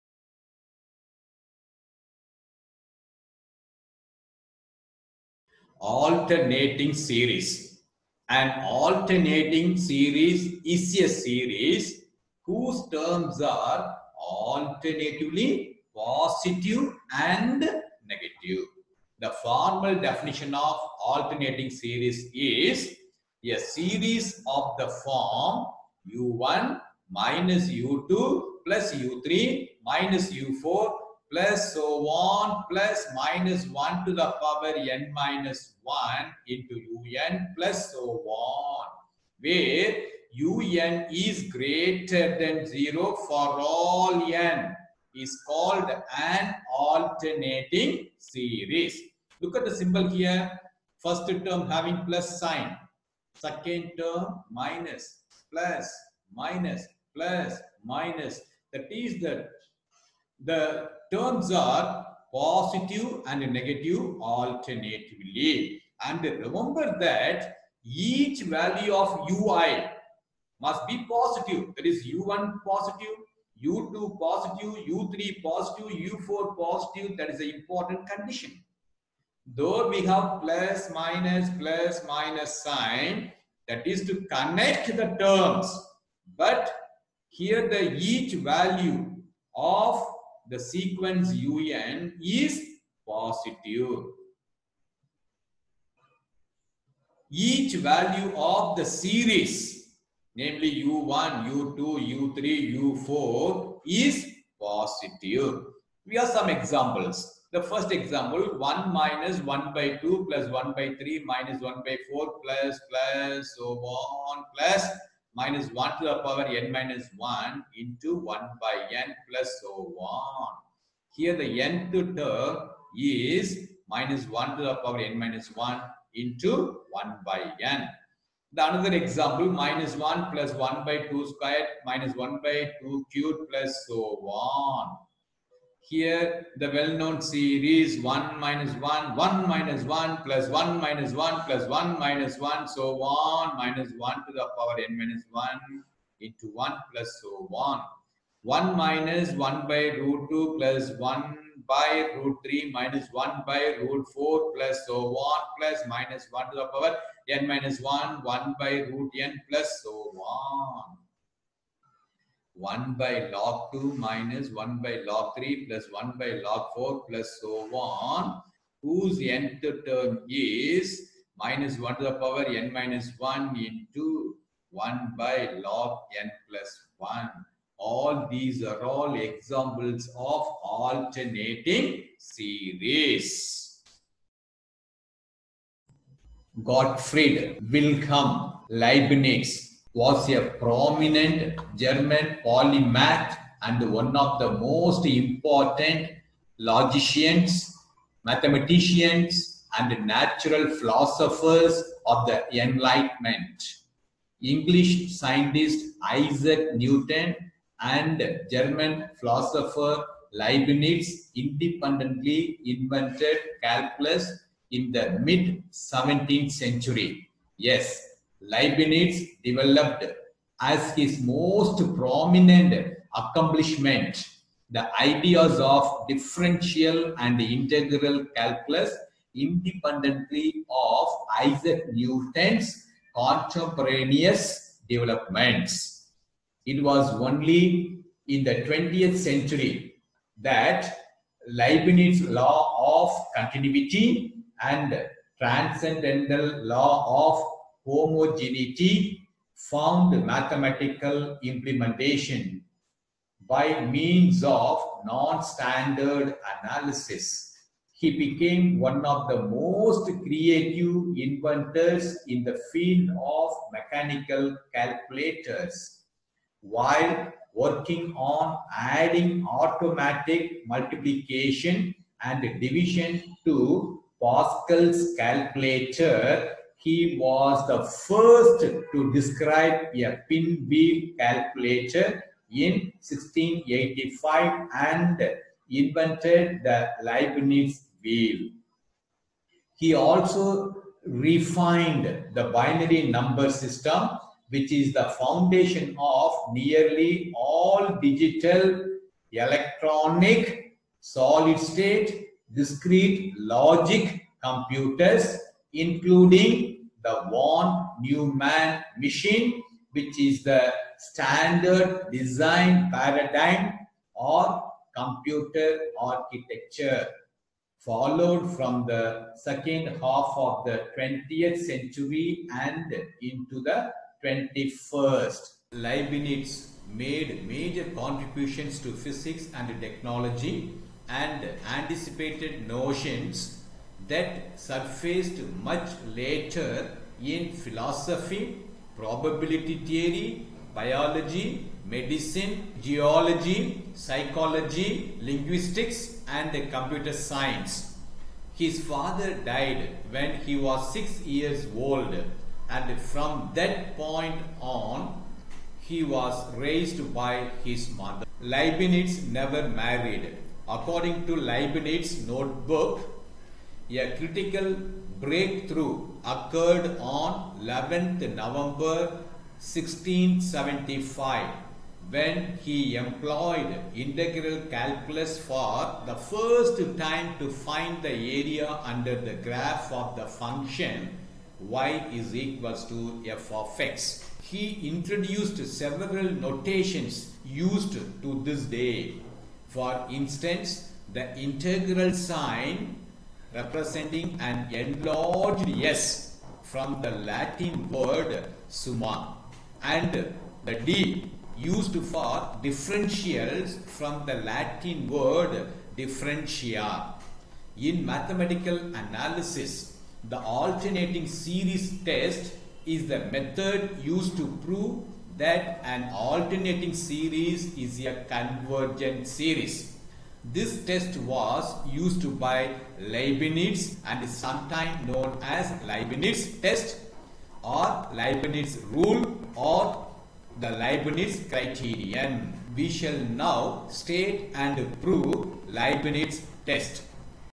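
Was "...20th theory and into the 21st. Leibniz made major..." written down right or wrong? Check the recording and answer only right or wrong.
wrong.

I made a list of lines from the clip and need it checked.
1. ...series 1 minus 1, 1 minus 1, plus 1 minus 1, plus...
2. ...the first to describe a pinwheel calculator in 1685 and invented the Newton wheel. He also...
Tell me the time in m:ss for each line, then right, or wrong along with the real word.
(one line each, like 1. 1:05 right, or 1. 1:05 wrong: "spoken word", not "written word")
1. 2:17 right
2. 4:37 wrong: "Leibniz", not "Newton".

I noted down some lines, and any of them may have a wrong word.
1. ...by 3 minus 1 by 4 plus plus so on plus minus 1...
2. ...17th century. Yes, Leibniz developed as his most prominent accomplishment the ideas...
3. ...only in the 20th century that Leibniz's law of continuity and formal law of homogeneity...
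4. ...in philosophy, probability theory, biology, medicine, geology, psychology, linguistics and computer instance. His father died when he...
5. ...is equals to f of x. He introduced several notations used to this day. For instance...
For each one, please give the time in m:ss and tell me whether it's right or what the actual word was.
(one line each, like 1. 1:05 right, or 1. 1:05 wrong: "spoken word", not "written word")
1. 1:50 right
2. 3:35 right
3. 3:57 wrong: "transcendental", not "formal"
4. 5:37 wrong: "science", not "instance"
5. 6:22 right.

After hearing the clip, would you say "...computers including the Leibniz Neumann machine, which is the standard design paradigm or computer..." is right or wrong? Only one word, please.
wrong.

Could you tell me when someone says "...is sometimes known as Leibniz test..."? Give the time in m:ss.
7:04.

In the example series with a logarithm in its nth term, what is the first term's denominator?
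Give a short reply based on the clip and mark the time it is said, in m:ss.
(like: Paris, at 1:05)
log 2, at 2:43.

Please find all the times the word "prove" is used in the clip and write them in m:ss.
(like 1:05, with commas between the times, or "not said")
6:54, 7:15.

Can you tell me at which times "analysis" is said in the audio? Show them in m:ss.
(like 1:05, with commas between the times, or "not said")
4:16, 6:48.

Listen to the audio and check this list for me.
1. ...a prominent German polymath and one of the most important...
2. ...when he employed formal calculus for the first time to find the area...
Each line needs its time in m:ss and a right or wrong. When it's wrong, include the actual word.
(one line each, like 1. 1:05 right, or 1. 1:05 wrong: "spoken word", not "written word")
1. 3:10 right
2. 6:12 wrong: "integral", not "formal".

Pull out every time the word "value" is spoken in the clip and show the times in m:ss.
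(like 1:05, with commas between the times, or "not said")
1:08, 1:28, 1:37.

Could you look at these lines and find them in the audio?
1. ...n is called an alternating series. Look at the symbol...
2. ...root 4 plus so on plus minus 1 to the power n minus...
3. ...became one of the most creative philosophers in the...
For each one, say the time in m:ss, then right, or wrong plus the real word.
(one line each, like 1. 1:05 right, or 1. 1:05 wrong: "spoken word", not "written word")
1. 0:44 right
2. 2:33 right
3. 4:18 wrong: "inventors", not "philosophers".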